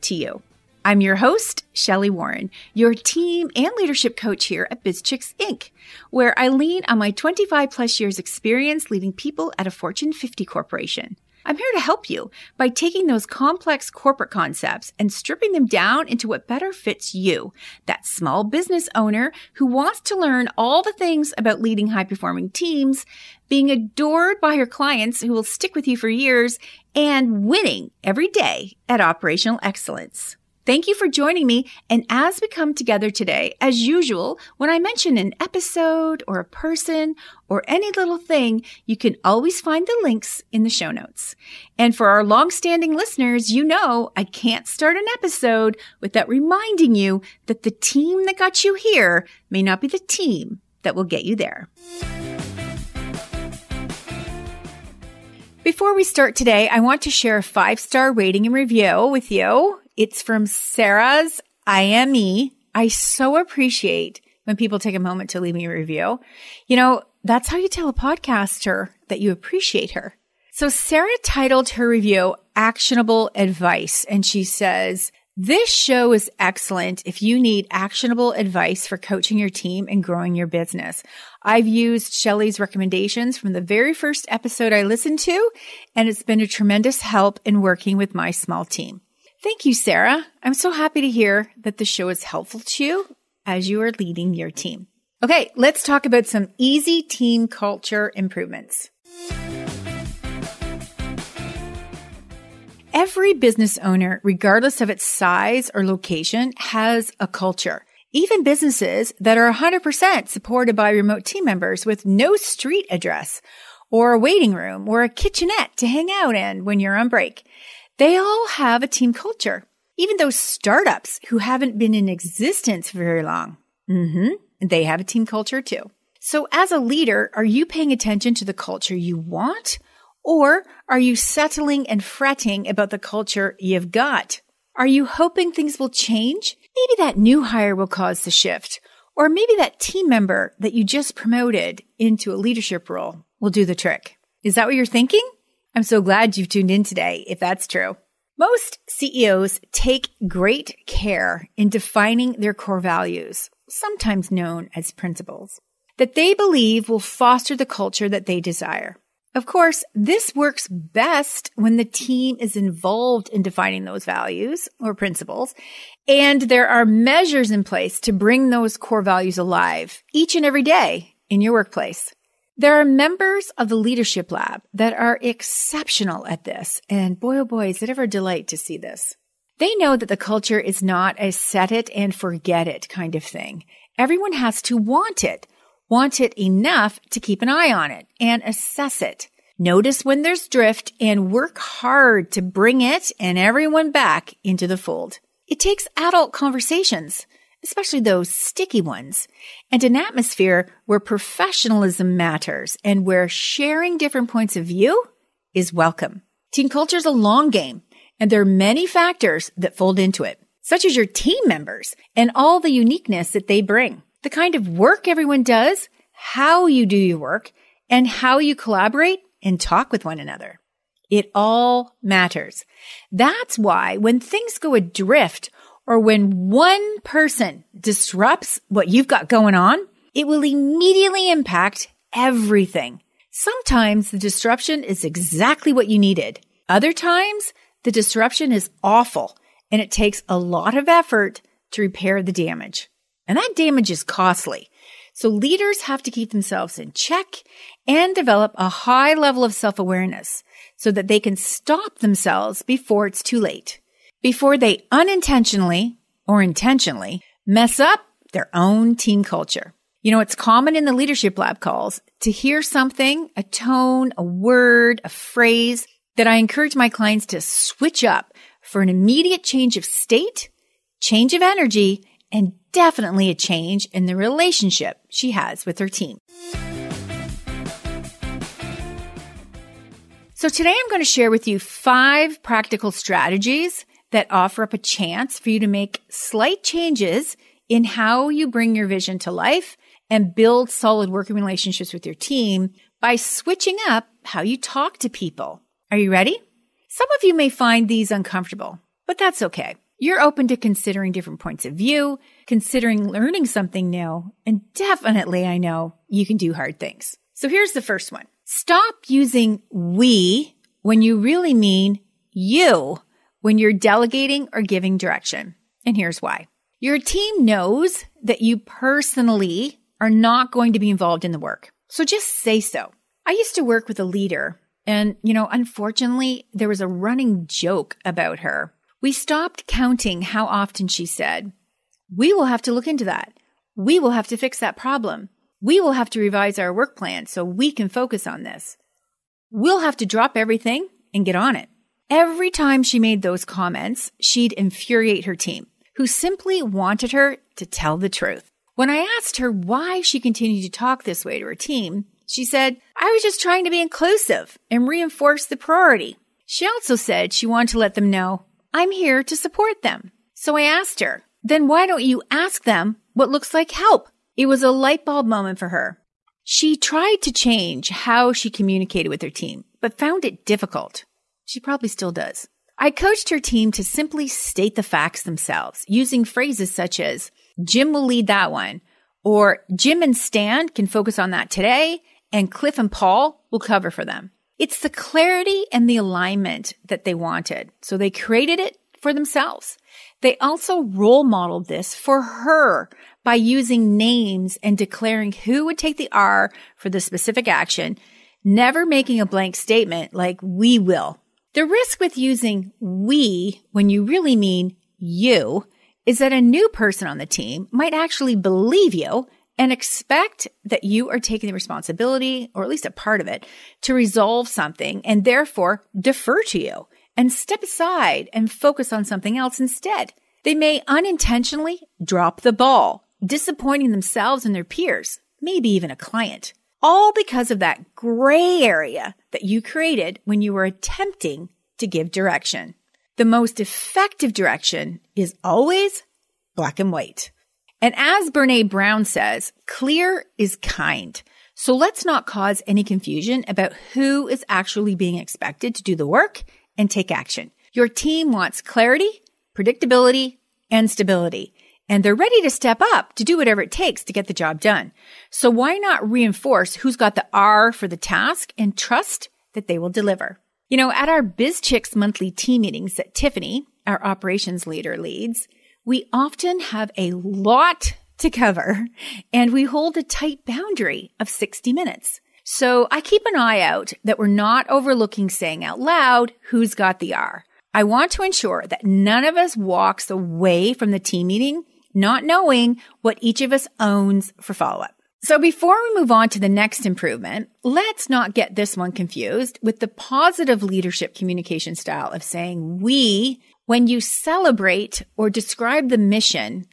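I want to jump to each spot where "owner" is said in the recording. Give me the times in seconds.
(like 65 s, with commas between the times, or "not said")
18 s, 103 s.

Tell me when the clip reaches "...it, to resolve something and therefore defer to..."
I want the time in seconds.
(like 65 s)
413 s.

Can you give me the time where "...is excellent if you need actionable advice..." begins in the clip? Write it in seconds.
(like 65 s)
76 s.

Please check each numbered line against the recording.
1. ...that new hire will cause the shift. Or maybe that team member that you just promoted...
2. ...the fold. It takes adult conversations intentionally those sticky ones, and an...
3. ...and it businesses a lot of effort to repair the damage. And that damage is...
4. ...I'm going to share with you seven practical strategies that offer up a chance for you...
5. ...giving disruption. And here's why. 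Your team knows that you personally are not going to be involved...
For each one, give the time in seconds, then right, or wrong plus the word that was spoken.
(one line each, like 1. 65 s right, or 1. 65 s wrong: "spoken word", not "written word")
1. 137 s right
2. 194 s wrong: "especially", not "intentionally"
3. 239 s wrong: "takes", not "businesses"
4. 280 s wrong: "five", not "seven"
5. 314 s wrong: "direction", not "disruption".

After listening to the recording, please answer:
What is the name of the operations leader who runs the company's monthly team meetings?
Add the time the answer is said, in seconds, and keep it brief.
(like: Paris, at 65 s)
Tiffany, at 463 s.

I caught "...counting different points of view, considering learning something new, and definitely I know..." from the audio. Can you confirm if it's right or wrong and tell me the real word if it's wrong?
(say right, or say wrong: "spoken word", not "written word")
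wrong: "considering", not "counting".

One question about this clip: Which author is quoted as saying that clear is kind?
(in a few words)
Brene Brown.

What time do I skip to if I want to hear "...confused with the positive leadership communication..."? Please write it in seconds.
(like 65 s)
488 s.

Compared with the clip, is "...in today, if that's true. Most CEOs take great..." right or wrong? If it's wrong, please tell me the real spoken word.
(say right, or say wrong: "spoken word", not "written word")
right.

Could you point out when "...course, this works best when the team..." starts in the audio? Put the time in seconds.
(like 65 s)
159 s.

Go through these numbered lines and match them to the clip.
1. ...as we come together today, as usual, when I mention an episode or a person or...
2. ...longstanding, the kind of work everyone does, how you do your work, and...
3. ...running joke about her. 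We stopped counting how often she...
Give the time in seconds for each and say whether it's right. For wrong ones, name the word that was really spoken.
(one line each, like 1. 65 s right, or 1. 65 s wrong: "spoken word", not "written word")
1. 32 s right
2. 213 s wrong: "bring", not "longstanding"
3. 326 s right.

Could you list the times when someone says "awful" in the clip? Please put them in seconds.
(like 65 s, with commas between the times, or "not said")
238 s.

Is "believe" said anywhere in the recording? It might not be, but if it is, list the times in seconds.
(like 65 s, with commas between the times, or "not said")
156 s, 408 s.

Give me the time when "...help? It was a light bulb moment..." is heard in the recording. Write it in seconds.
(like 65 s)
363 s.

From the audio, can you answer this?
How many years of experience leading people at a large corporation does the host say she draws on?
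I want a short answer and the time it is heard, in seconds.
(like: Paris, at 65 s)
25, at 7 s.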